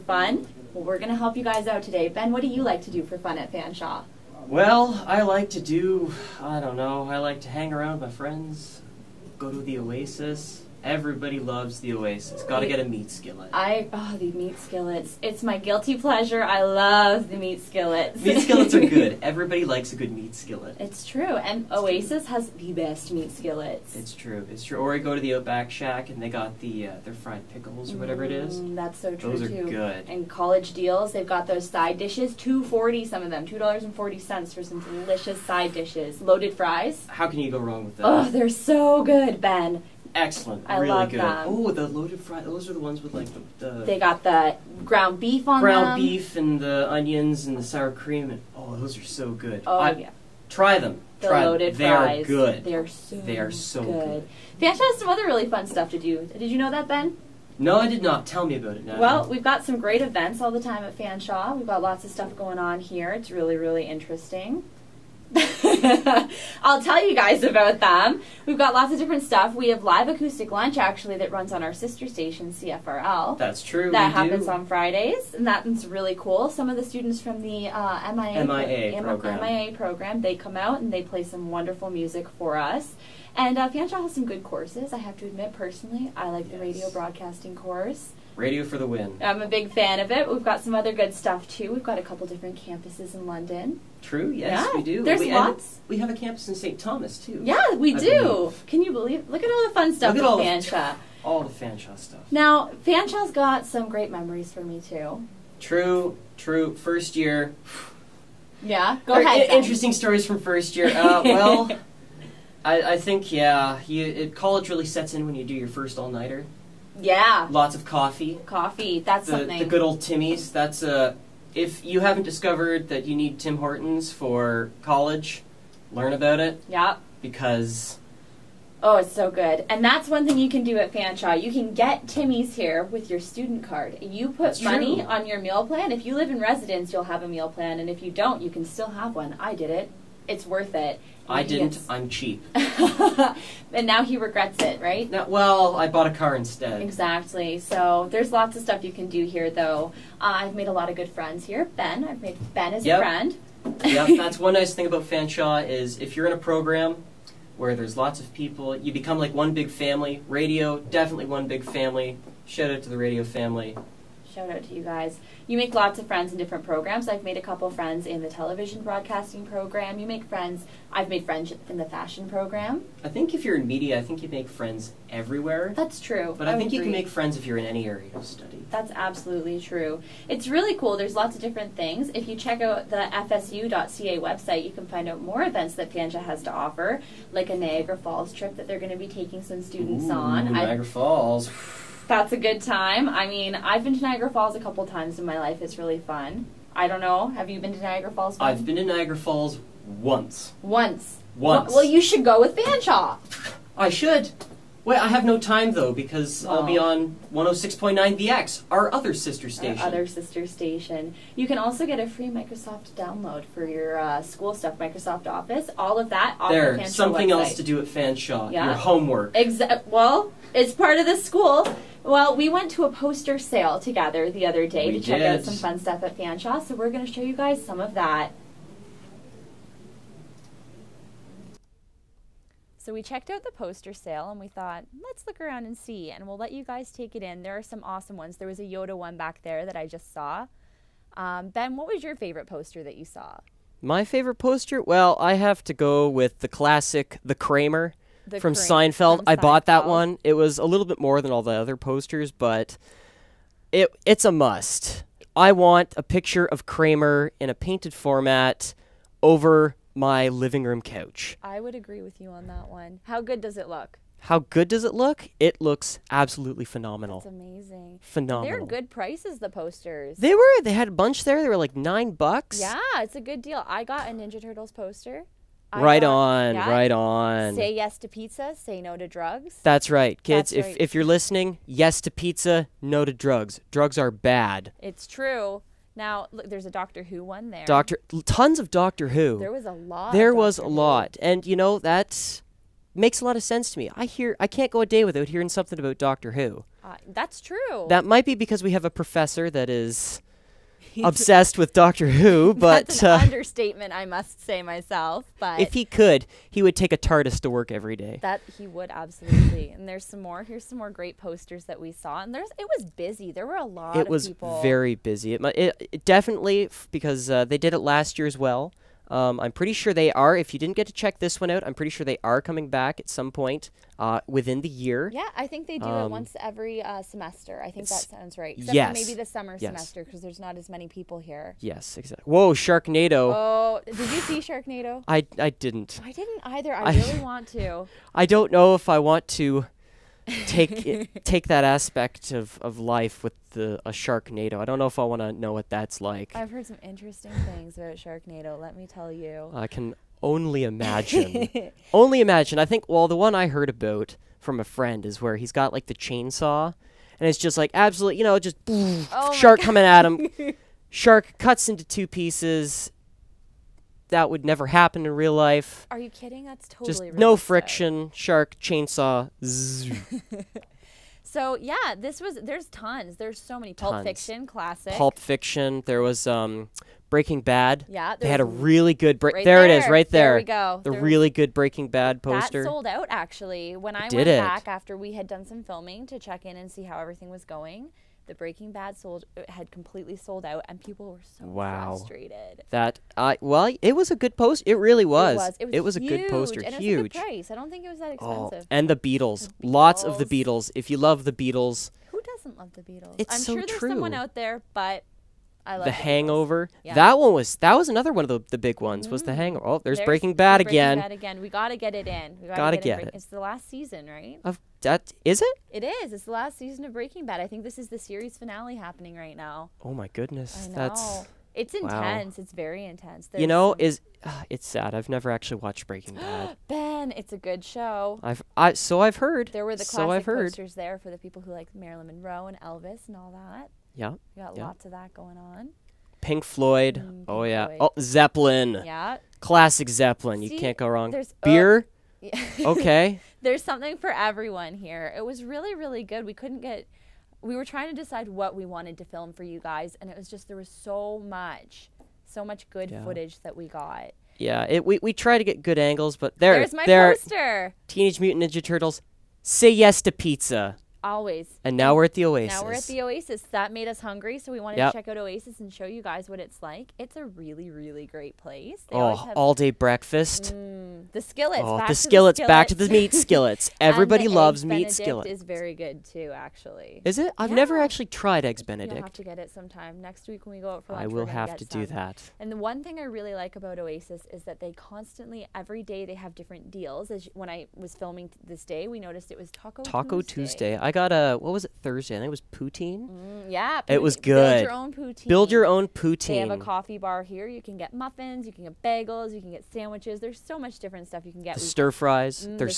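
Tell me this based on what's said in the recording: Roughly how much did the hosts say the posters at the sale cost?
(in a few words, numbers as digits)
9 dollars.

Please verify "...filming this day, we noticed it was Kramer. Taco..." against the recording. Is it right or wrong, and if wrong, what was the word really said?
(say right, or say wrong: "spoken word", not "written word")
wrong: "Taco", not "Kramer".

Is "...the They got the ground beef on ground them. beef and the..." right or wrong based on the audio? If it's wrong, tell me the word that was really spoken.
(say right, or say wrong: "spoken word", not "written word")
right.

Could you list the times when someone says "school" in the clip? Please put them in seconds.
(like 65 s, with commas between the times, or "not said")
214 s, 221 s.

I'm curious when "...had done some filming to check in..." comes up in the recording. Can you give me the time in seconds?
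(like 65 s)
385 s.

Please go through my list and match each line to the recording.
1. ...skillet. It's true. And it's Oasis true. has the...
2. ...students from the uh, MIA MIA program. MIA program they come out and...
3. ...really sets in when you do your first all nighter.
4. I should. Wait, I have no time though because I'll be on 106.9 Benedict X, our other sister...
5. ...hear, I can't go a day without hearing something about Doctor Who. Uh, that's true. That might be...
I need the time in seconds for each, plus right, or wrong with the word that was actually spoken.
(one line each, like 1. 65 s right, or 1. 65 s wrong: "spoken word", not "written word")
1. 20 s right
2. 76 s right
3. 114 s right
4. 203 s wrong: "The", not "Benedict"
5. 294 s right.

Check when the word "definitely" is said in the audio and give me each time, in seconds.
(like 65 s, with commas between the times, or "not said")
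160 s, 316 s.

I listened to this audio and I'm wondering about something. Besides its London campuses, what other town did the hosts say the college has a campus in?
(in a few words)
St. Thomas.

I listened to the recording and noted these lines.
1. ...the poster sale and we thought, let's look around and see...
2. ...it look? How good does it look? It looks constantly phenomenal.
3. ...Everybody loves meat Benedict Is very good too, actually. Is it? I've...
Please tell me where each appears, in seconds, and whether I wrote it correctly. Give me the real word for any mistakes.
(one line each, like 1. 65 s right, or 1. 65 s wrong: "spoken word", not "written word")
1. 233 s right
2. 263 s wrong: "absolutely", not "constantly"
3. 473 s right.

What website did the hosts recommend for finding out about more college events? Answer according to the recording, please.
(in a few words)
fsu.ca.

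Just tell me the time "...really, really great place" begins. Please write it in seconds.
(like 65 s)
467 s.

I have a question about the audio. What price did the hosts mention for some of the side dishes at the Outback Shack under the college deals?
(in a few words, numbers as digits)
$2.40.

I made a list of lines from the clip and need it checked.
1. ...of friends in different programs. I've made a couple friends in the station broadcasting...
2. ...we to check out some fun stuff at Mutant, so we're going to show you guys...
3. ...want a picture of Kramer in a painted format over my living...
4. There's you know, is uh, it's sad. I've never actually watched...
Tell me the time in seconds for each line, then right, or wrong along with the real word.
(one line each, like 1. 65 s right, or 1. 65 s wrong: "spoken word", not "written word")
1. 165 s wrong: "television", not "station"
2. 224 s wrong: "Fanshawe", not "Mutant"
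3. 255 s right
4. 423 s right.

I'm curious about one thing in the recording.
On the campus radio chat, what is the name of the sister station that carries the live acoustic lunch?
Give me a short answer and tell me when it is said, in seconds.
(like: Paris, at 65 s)
CFRL, at 72 s.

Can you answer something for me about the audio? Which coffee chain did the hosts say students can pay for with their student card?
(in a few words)
Tim Hortons.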